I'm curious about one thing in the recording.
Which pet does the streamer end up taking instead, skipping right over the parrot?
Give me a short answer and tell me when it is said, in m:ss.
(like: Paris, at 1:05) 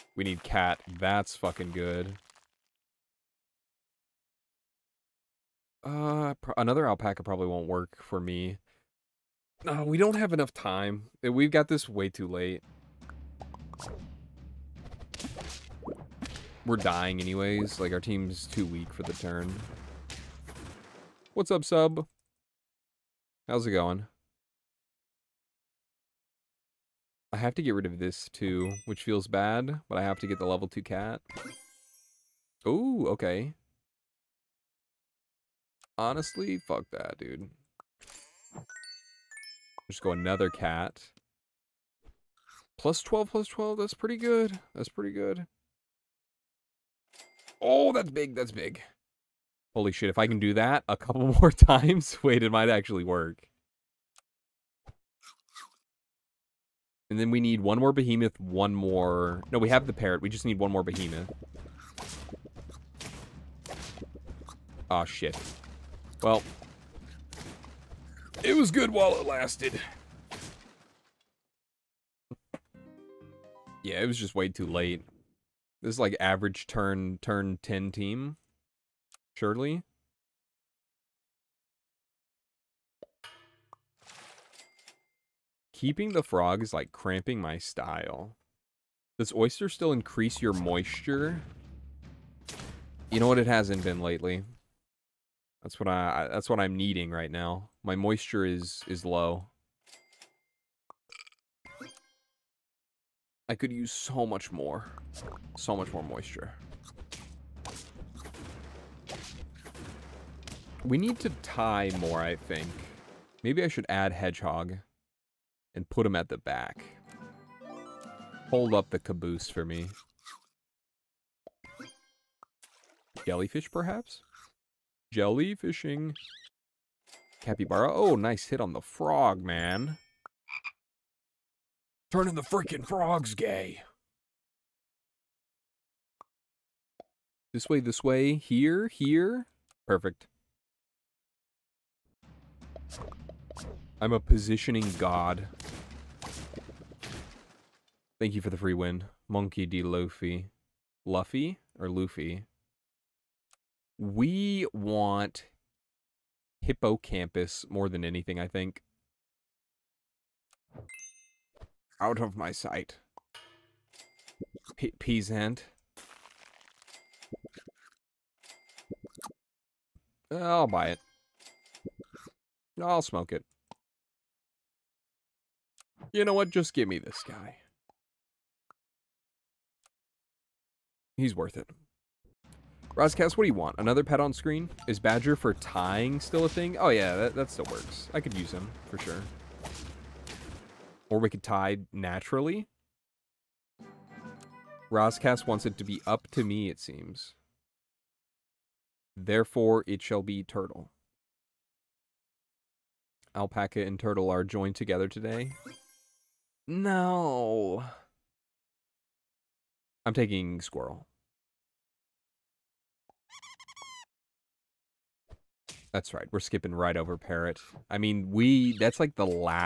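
squirrel, at 3:30.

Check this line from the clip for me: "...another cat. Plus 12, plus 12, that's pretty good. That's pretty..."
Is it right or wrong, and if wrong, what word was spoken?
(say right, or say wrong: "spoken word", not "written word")
right.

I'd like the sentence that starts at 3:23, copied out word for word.
Alpaca and turtle are joined together today.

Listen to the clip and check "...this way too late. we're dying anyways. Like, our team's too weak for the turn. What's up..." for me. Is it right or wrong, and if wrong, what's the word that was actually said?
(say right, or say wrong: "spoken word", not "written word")
right.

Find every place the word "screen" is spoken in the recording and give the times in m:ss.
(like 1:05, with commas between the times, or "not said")
3:04.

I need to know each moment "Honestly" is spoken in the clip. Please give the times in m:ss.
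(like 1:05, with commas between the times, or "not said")
0:35.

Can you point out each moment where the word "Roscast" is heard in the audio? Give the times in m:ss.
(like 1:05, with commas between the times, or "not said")
3:02, 3:14.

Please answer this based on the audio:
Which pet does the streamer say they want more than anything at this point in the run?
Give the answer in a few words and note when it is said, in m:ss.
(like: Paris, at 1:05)
Hippocampus, at 2:36.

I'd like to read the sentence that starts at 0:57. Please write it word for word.
And then we need one more behemoth, one more...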